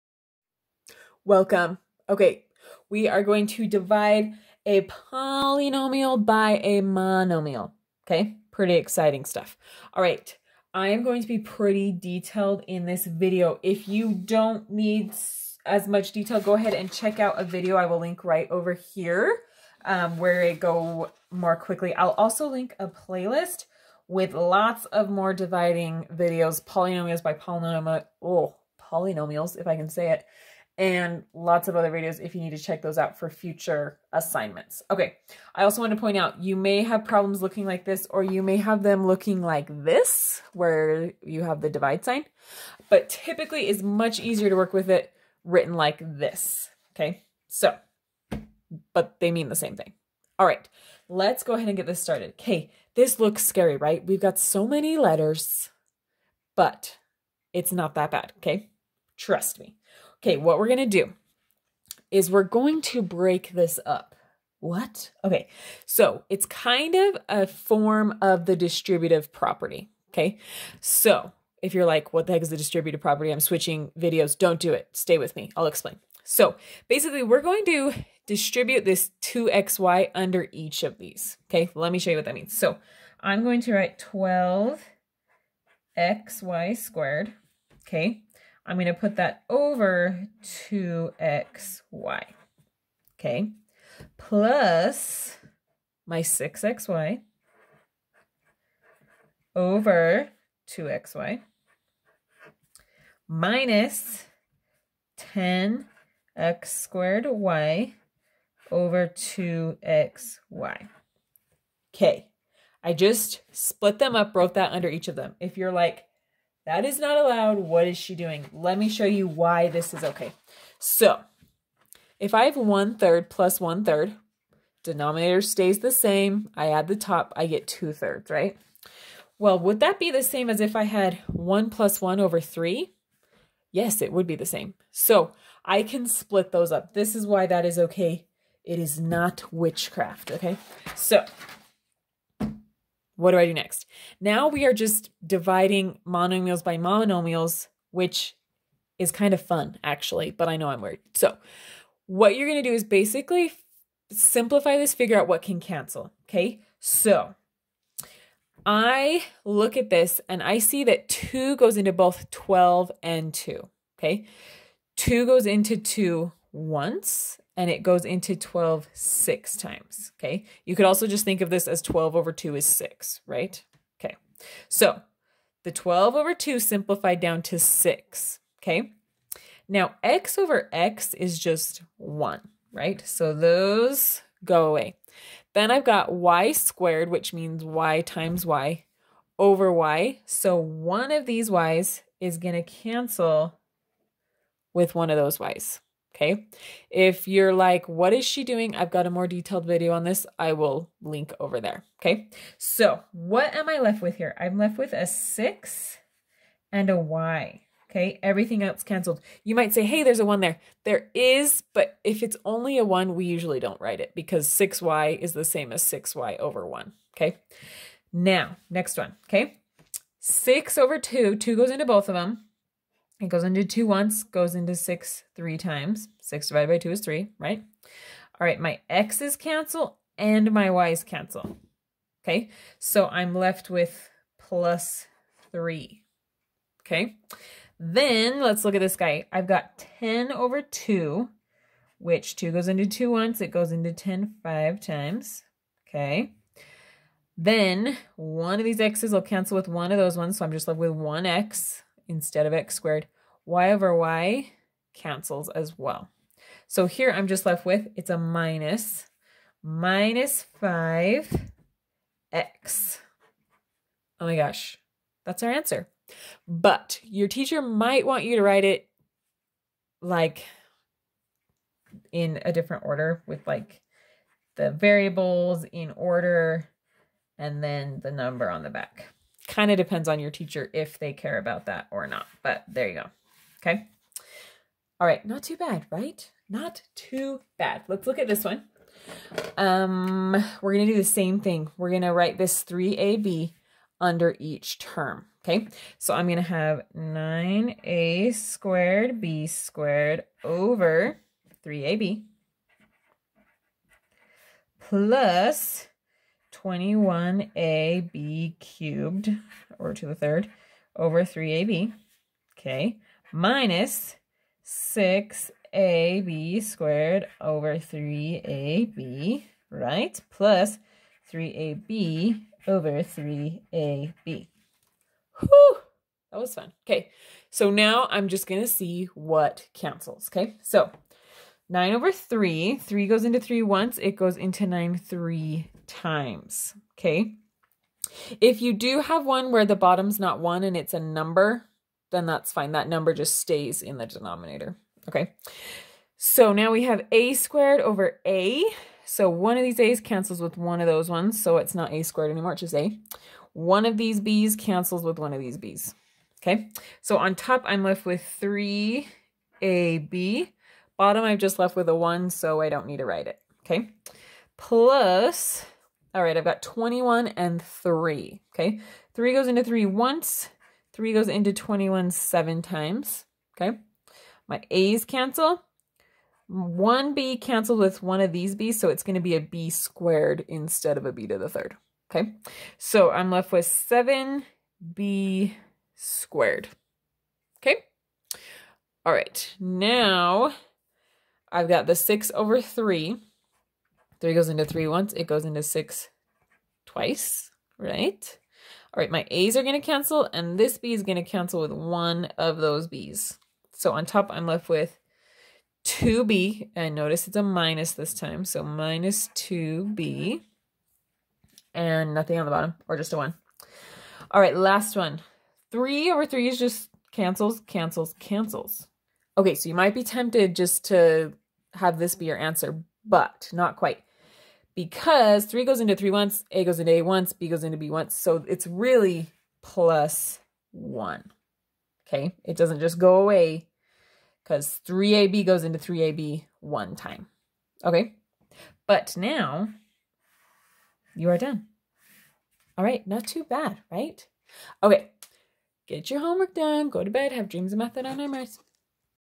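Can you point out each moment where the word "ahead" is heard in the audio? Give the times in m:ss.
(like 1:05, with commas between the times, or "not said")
0:16, 0:51.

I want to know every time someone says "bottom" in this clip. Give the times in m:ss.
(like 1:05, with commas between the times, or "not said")
5:39, 6:00, 6:52.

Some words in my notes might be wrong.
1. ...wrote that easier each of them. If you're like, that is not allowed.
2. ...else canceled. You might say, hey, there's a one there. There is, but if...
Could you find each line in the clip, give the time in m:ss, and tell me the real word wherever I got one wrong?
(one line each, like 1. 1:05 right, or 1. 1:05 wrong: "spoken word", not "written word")
1. 1:54 wrong: "under", not "easier"
2. 3:28 right.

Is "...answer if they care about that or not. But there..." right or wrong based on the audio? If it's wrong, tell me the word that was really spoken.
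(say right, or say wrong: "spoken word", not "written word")
wrong: "teacher", not "answer".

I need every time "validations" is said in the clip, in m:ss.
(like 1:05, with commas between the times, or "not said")
not said.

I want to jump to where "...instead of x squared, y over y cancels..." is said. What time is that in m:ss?
4:12.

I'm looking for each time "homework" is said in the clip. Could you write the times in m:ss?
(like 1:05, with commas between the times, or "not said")
7:26.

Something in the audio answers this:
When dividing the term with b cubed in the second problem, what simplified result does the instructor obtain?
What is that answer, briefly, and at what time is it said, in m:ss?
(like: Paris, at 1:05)
7b^2, at 6:23.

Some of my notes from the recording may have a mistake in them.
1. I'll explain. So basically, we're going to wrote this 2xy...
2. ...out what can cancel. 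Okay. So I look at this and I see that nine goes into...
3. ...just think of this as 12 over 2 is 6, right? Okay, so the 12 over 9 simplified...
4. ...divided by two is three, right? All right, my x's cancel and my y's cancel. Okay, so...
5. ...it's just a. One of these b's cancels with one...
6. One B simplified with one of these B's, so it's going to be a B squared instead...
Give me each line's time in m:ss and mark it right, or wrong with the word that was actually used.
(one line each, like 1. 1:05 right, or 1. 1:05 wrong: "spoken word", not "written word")
1. 1:15 wrong: "distribute", not "wrote"
2. 2:35 wrong: "two", not "nine"
3. 2:51 wrong: "2", not "9"
4. 3:46 right
5. 5:52 right
6. 6:16 wrong: "canceled", not "simplified".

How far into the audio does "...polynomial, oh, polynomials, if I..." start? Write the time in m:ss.
0:27.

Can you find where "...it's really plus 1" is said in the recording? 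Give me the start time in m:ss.
7:08.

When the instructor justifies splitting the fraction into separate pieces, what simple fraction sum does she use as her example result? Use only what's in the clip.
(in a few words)
2/3.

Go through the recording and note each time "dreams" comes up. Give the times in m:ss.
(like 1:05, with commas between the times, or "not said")
7:27.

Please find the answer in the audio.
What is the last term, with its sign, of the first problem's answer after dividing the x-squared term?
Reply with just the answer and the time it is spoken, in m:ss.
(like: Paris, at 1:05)
-5x, at 4:19.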